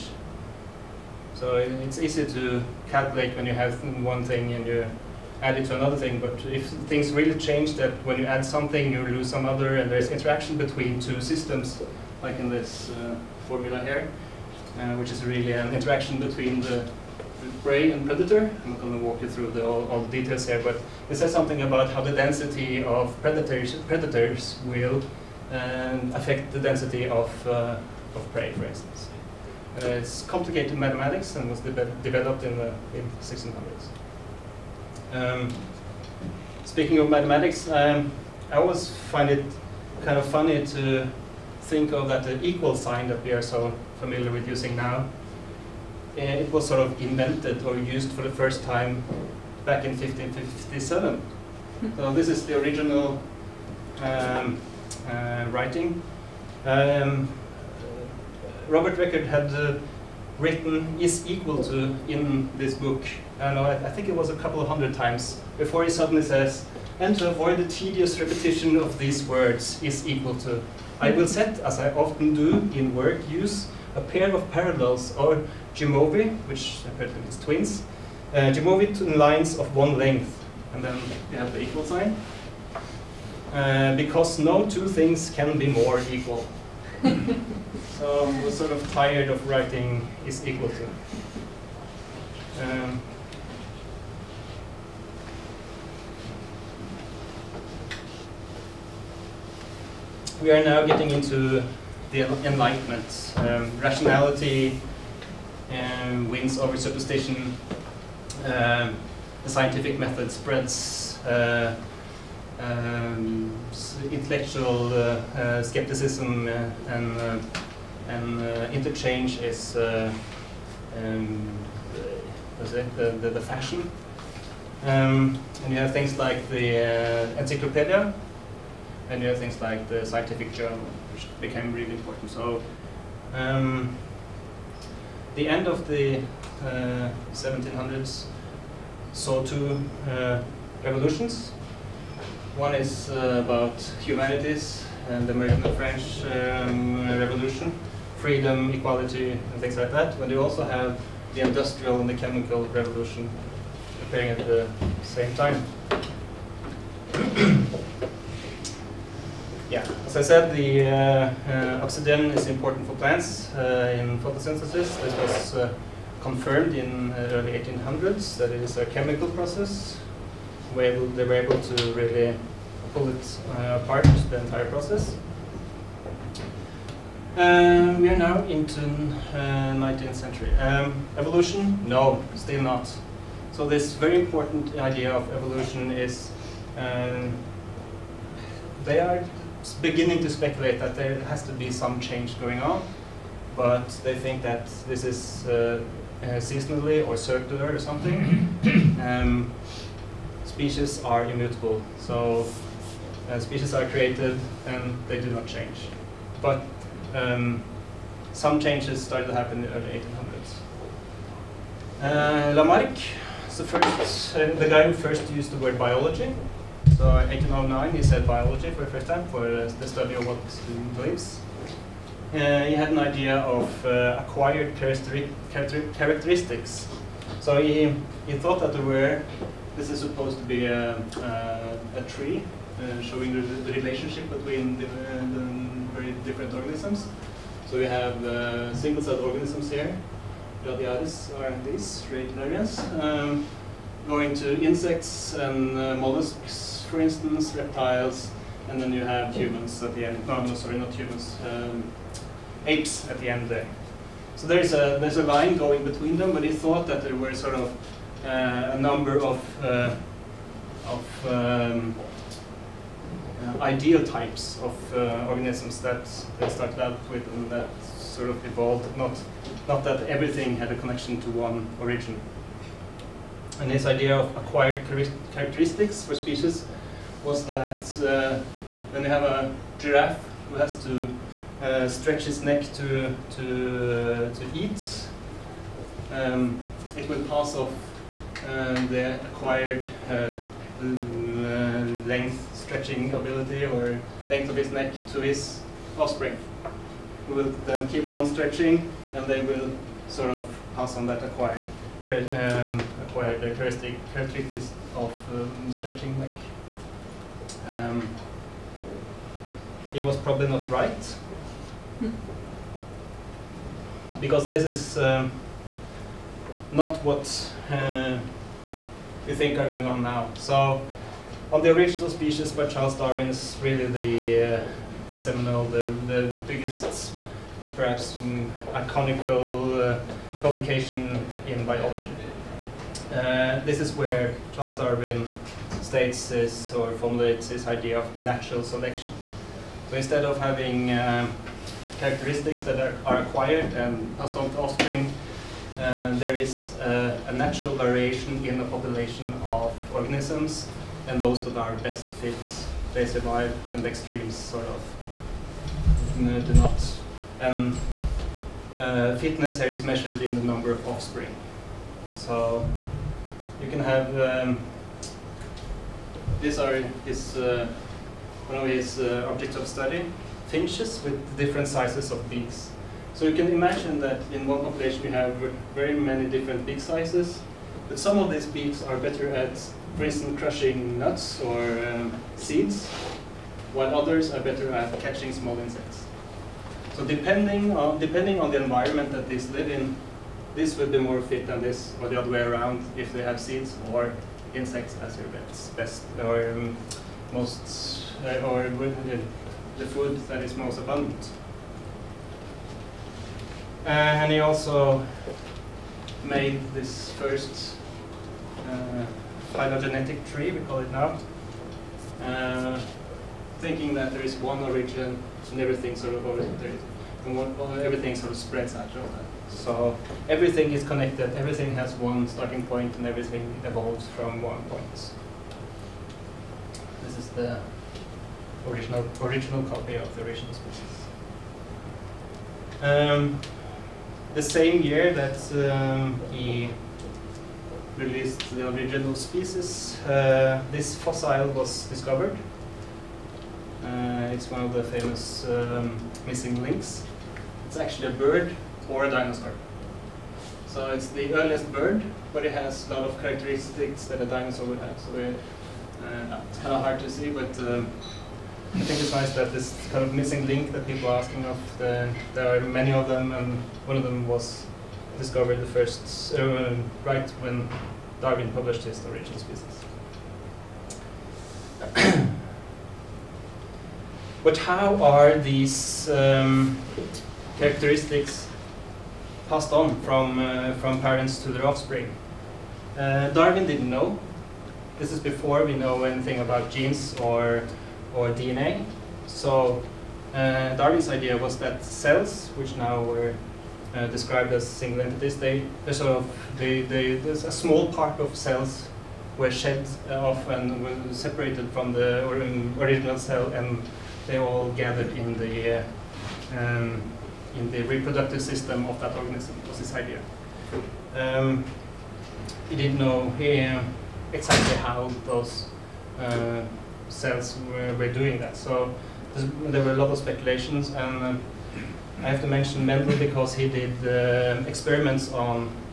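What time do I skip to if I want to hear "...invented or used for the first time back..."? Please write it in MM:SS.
00:47.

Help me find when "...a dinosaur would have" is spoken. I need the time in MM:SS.
07:34.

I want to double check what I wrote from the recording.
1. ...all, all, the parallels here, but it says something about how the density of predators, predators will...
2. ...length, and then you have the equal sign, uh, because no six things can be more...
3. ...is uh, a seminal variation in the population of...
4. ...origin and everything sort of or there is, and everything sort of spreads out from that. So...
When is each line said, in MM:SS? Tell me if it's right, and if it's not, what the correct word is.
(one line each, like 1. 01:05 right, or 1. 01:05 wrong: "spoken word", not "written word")
1. 00:19 wrong: "details", not "parallels"
2. 01:19 wrong: "two", not "six"
3. 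05:46 wrong: "natural", not "seminal"
4. 06:54 right.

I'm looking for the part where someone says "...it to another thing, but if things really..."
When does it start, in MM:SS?
00:05.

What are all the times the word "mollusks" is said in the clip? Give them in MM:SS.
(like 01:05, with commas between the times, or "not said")
04:05.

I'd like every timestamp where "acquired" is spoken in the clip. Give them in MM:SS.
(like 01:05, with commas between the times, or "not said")
03:44, 04:34, 04:49, 05:01, 05:43.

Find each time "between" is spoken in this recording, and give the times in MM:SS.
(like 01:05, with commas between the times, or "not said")
00:10, 00:16, 03:54, 04:15.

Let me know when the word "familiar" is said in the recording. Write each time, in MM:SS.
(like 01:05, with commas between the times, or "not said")
00:43.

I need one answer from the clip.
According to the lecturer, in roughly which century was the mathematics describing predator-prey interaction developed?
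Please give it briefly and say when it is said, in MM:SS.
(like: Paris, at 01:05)
1600s, at 00:33.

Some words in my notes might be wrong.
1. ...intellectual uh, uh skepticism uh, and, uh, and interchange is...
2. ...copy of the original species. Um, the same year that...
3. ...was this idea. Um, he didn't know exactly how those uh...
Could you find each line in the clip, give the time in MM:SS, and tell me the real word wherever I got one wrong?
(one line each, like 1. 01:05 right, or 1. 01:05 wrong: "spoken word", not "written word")
1. 01:54 right
2. 07:09 right
3. 08:29 right.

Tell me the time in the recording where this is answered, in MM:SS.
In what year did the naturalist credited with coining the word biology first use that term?
03:37.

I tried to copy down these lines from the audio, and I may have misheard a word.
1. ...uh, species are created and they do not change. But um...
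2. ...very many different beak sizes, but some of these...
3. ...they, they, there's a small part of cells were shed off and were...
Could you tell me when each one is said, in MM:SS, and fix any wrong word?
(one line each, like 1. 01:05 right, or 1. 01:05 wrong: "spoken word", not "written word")
1. 03:23 right
2. 06:15 right
3. 08:16 right.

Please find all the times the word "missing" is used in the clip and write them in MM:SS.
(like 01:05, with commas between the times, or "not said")
07:26, 07:40.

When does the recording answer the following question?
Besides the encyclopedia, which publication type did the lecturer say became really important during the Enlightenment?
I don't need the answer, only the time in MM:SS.
02:09.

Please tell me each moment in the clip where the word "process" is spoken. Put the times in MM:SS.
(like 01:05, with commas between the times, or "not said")
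02:49, 02:54.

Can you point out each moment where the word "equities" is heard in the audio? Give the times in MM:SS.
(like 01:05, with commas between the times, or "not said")
not said.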